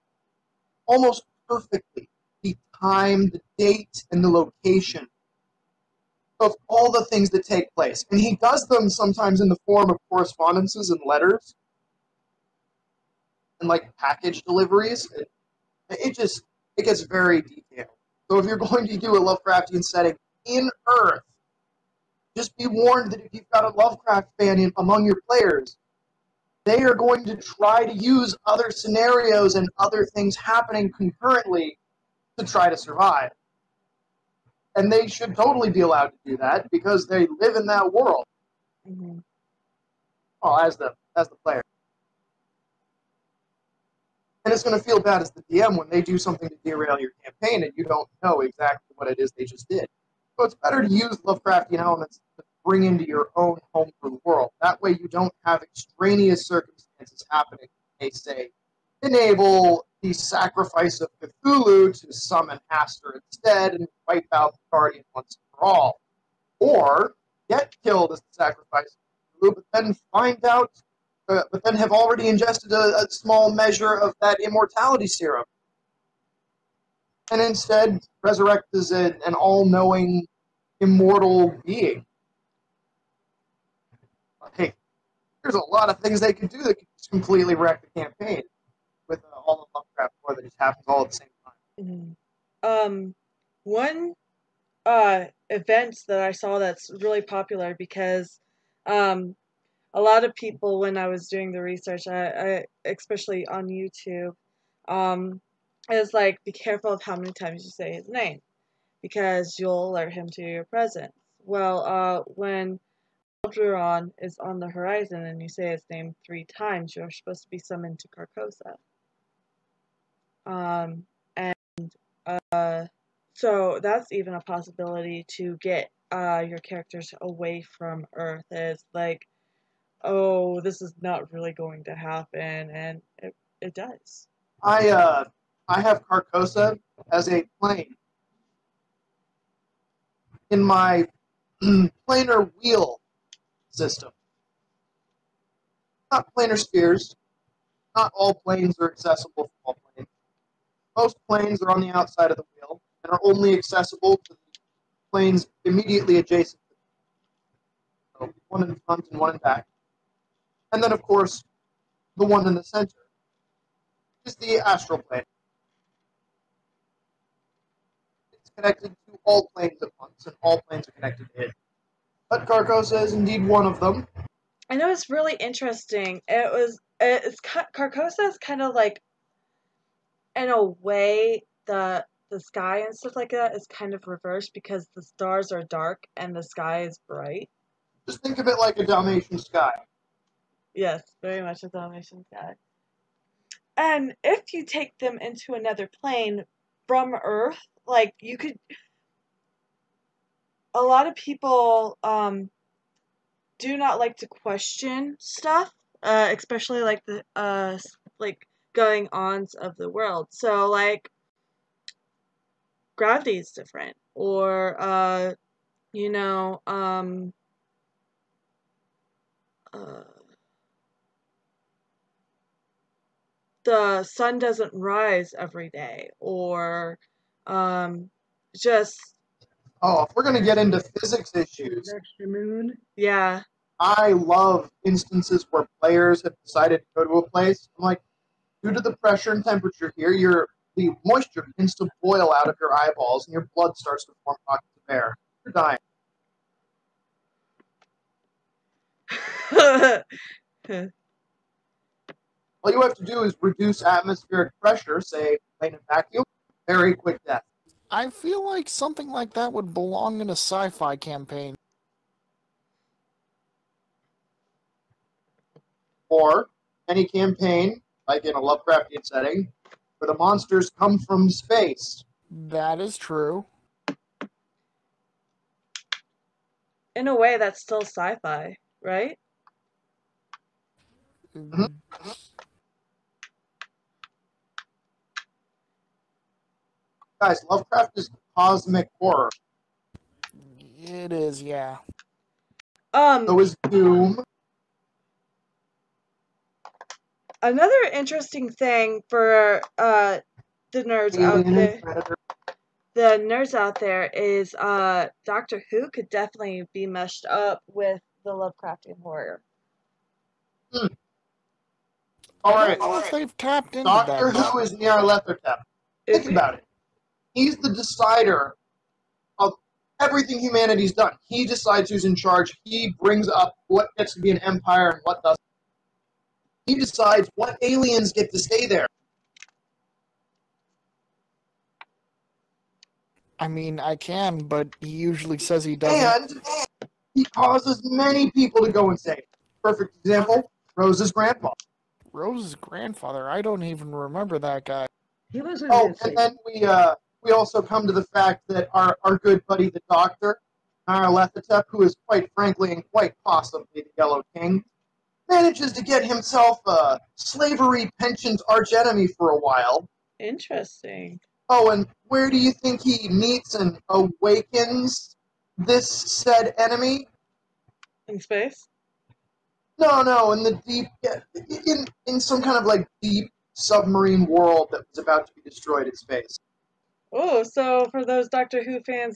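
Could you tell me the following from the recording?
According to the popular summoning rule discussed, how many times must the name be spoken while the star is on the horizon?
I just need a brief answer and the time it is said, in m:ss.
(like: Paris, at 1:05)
3, at 1:56.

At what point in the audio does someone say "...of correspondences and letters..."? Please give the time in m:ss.
0:09.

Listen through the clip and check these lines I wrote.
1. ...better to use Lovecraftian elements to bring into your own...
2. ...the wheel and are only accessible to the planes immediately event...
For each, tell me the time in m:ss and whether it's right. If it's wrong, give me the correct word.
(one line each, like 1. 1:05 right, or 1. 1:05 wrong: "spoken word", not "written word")
1. 0:50 right
2. 2:32 wrong: "adjacent", not "event".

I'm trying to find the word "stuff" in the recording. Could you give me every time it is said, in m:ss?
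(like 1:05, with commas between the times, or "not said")
3:02, 3:25.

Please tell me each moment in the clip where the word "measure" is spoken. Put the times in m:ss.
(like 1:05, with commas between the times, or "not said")
1:13.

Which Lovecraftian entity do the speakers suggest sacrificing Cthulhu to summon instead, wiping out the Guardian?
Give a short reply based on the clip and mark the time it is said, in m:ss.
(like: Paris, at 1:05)
Hastur, at 1:02.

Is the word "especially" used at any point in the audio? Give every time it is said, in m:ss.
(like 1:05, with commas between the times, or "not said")
1:42, 3:26.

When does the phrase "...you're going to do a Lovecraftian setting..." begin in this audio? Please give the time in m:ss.
0:18.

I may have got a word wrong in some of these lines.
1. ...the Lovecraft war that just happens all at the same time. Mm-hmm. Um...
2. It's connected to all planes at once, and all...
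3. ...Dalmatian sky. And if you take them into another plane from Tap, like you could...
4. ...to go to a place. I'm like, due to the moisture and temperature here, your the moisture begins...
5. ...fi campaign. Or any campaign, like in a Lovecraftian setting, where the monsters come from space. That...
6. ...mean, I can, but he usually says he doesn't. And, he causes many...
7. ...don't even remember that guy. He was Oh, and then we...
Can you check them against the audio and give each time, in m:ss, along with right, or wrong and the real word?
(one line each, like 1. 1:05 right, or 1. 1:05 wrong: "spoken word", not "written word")
1. 1:29 right
2. 2:48 right
3. 3:11 wrong: "Earth", not "Tap"
4. 3:56 wrong: "pressure", not "moisture"
5. 4:20 right
6. 5:33 right
7. 5:43 right.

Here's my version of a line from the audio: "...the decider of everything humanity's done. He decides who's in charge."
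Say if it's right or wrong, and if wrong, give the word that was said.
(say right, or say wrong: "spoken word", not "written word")
right.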